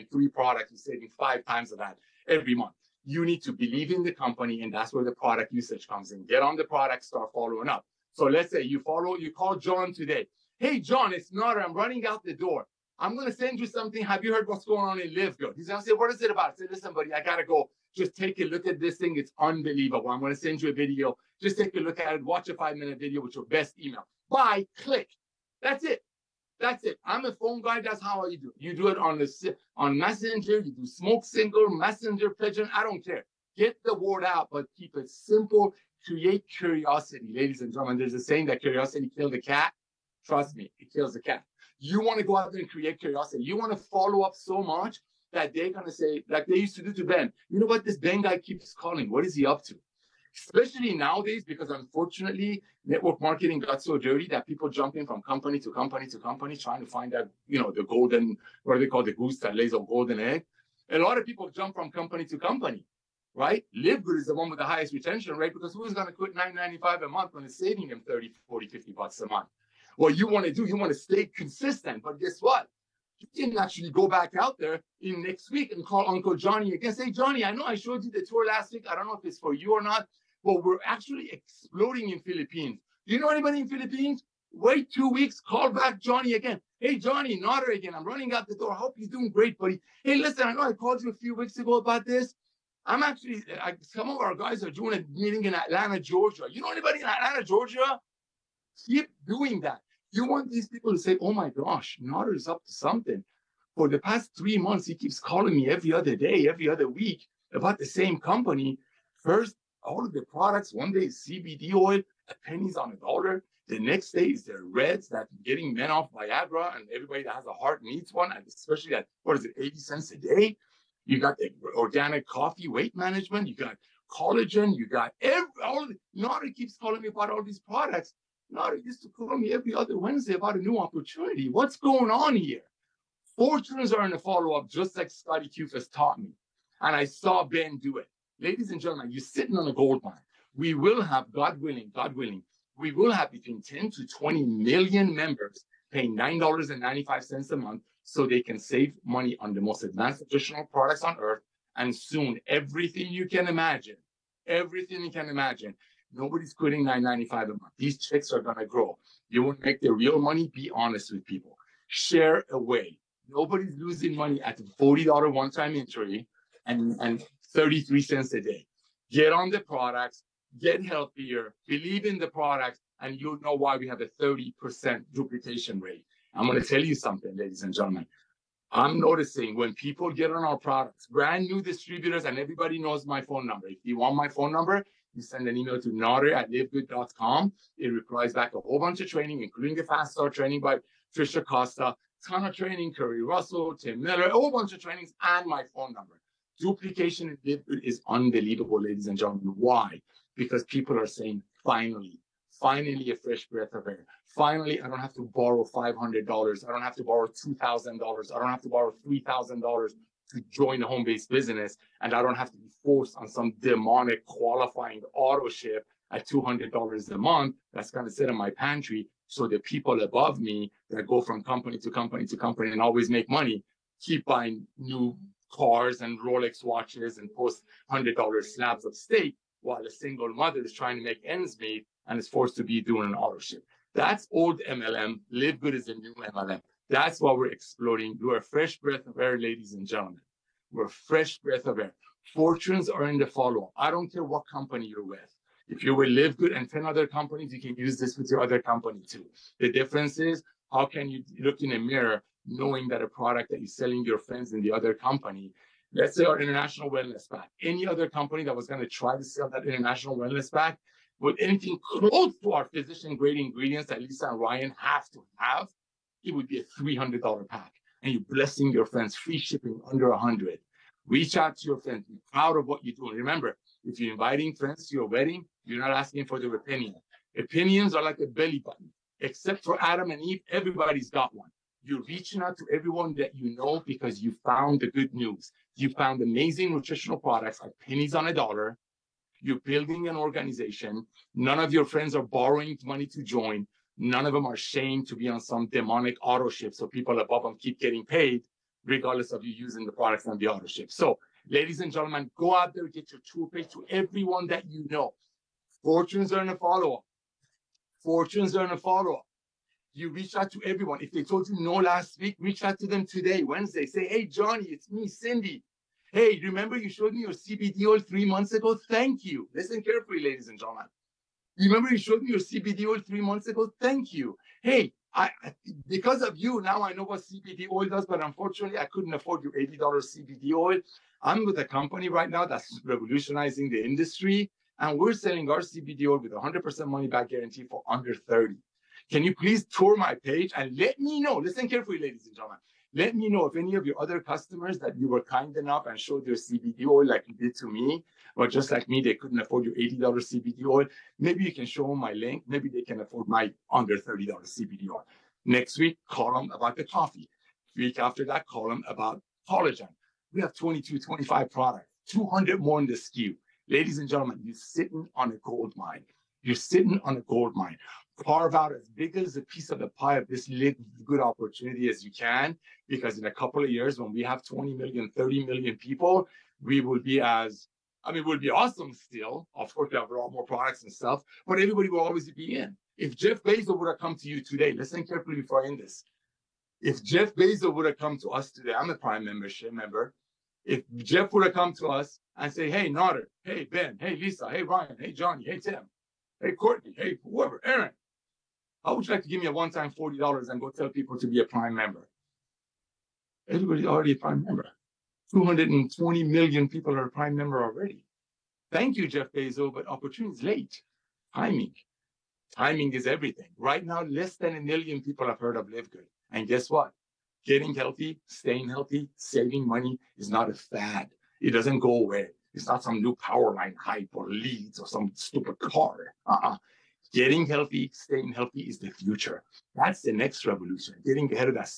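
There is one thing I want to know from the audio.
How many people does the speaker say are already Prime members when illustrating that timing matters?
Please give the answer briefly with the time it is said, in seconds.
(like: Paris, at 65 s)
220 million, at 405 s.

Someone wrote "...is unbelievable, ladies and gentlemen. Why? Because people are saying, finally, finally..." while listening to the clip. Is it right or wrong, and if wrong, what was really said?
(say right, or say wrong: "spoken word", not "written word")
right.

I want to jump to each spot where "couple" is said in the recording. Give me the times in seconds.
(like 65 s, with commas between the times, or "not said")
373 s.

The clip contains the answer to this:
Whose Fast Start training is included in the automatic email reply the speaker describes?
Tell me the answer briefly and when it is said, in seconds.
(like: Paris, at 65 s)
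Trisha Costa, at 191 s.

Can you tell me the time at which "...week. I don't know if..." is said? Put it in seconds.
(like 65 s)
78 s.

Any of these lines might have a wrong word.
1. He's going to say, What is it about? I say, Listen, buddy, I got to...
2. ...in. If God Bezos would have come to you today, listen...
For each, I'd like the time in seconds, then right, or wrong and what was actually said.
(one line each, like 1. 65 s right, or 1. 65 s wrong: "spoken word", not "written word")
1. 15 s right
2. 382 s wrong: "Jeff", not "God".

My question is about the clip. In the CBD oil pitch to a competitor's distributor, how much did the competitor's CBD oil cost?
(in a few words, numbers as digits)
$80.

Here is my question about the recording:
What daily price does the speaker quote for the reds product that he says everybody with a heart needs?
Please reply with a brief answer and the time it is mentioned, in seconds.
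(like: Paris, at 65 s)
80 cents a day, at 119 s.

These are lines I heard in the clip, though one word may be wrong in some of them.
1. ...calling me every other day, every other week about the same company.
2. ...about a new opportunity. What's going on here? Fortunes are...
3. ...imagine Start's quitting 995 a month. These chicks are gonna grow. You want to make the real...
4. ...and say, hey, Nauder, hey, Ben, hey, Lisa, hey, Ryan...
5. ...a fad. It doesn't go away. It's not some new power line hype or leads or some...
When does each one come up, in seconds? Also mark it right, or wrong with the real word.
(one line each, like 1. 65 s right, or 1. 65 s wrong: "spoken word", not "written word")
1. 105 s right
2. 130 s right
3. 155 s wrong: "Nobody", not "Start"
4. 392 s right
5. 420 s right.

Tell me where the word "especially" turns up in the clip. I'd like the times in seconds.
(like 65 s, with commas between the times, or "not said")
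50 s, 118 s.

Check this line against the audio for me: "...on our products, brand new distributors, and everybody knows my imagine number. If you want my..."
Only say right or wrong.
wrong.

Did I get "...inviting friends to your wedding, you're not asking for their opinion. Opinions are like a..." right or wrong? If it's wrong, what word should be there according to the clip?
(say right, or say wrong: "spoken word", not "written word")
right.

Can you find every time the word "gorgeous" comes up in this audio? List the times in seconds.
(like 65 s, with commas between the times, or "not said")
not said.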